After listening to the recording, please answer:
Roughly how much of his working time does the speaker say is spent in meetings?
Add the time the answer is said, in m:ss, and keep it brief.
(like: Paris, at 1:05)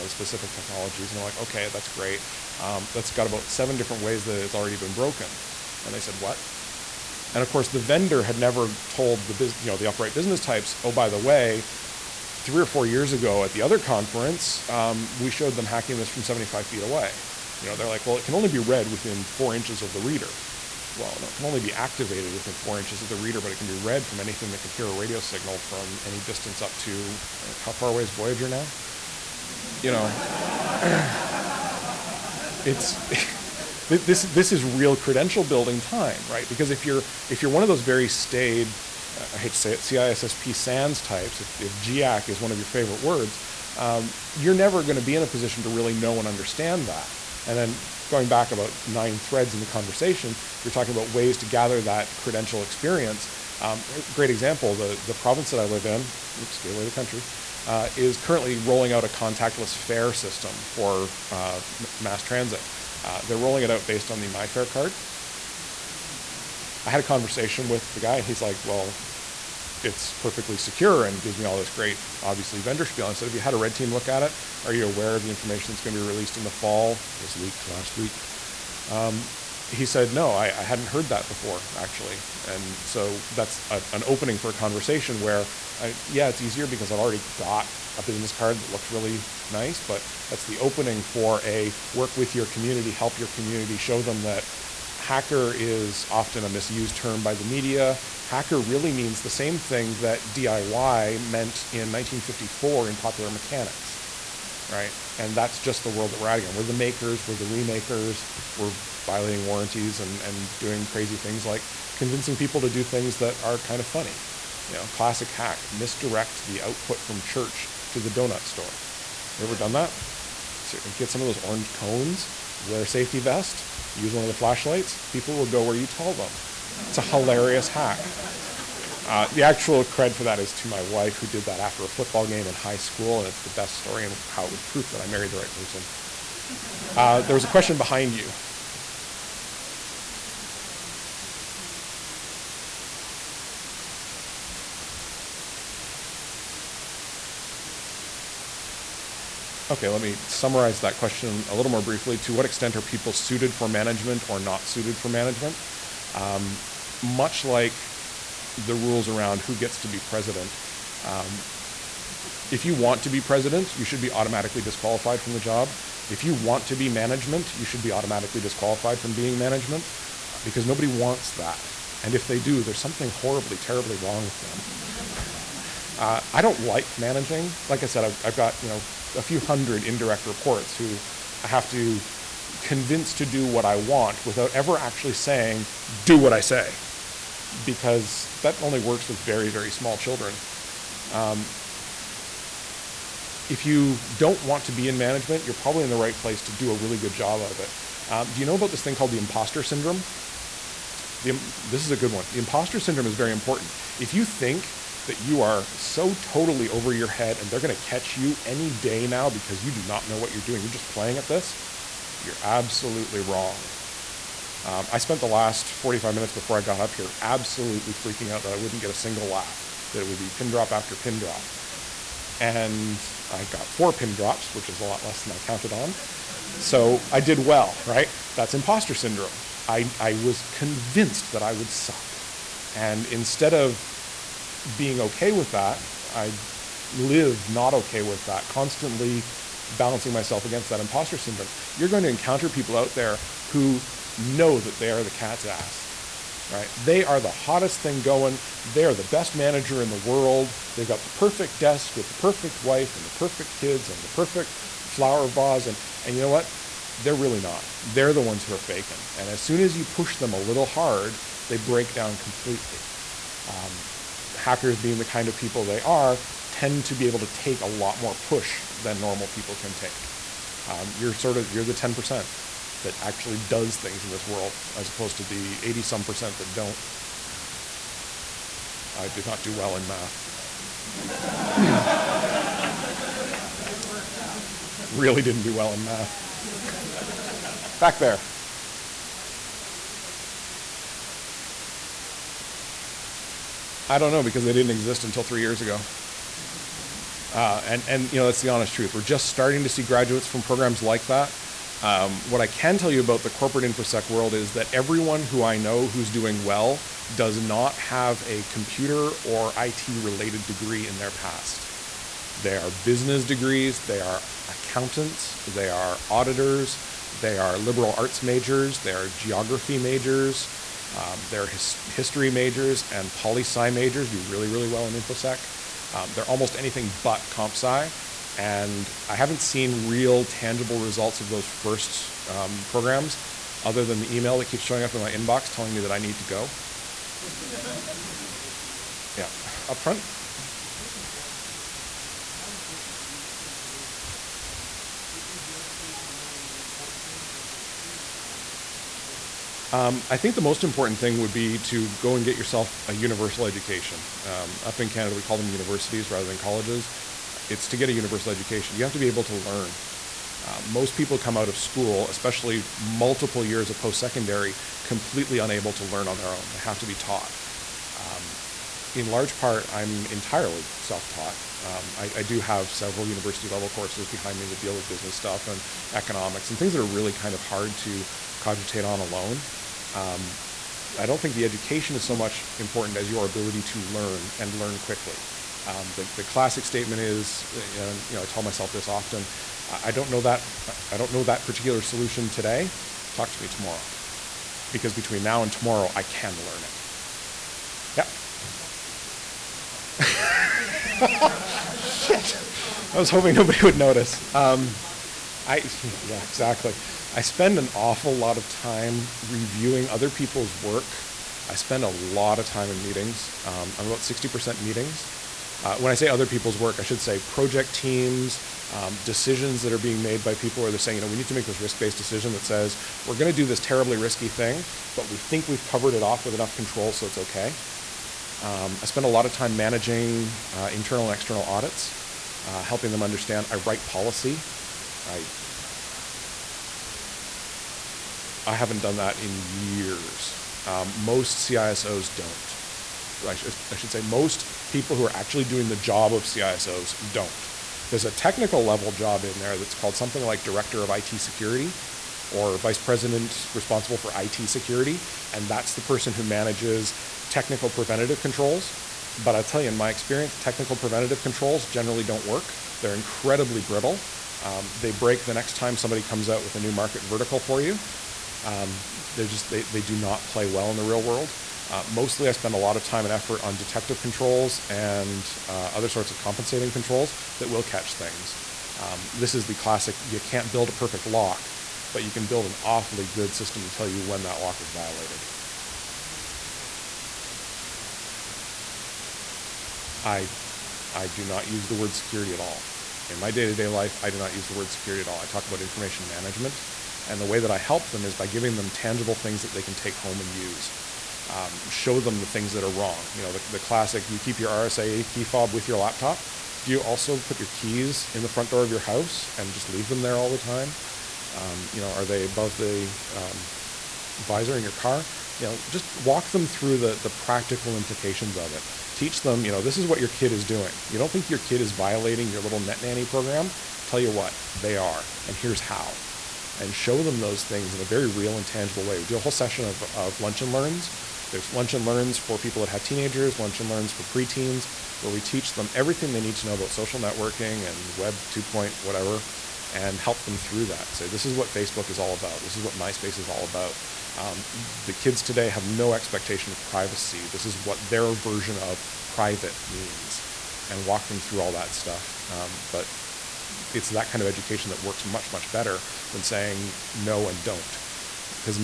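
60%, at 6:53.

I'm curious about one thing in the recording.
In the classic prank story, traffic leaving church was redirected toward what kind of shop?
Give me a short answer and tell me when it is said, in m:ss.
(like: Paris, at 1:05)
donut store, at 1:58.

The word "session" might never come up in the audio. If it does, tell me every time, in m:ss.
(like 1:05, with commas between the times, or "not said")
8:49.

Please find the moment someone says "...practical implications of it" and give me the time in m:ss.
8:37.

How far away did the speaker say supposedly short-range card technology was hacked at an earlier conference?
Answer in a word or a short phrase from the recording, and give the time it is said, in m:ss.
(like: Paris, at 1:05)
75 feet, at 0:16.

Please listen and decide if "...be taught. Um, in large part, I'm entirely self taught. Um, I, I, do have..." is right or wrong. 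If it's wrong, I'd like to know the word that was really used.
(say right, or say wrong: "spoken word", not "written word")
right.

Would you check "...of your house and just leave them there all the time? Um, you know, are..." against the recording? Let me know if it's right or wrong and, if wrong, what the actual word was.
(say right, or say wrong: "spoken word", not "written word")
right.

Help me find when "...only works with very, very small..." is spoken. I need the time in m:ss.
3:08.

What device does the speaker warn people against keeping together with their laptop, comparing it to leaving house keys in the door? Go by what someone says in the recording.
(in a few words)
RSA key fob.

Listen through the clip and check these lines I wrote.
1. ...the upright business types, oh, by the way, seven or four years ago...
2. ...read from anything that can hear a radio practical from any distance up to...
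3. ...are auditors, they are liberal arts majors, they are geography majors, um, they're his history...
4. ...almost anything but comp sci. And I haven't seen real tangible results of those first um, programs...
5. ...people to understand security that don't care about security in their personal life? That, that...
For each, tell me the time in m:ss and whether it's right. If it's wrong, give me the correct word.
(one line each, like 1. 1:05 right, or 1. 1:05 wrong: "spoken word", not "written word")
1. 0:09 wrong: "three", not "seven"
2. 0:23 wrong: "signal", not "practical"
3. 5:15 right
4. 5:26 right
5. 8:06 right.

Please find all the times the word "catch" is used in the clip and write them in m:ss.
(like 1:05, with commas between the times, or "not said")
3:27, 7:57.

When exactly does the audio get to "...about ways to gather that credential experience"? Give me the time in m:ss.
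0:50.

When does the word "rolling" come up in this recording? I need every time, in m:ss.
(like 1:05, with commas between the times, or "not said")
0:58, 1:03.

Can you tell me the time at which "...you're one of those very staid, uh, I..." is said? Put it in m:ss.
0:37.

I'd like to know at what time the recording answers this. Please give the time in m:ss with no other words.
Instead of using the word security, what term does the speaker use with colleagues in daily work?
8:15.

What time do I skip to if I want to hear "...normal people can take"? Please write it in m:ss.
4:28.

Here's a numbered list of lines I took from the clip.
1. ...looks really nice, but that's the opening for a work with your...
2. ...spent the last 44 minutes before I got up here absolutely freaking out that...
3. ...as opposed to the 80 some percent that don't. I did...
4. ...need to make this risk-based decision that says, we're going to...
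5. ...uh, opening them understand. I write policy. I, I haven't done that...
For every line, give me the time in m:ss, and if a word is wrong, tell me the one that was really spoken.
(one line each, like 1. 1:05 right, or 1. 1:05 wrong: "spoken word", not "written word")
1. 1:28 right
2. 3:34 wrong: "45", not "44"
3. 4:34 right
4. 7:01 right
5. 7:12 wrong: "helping", not "opening".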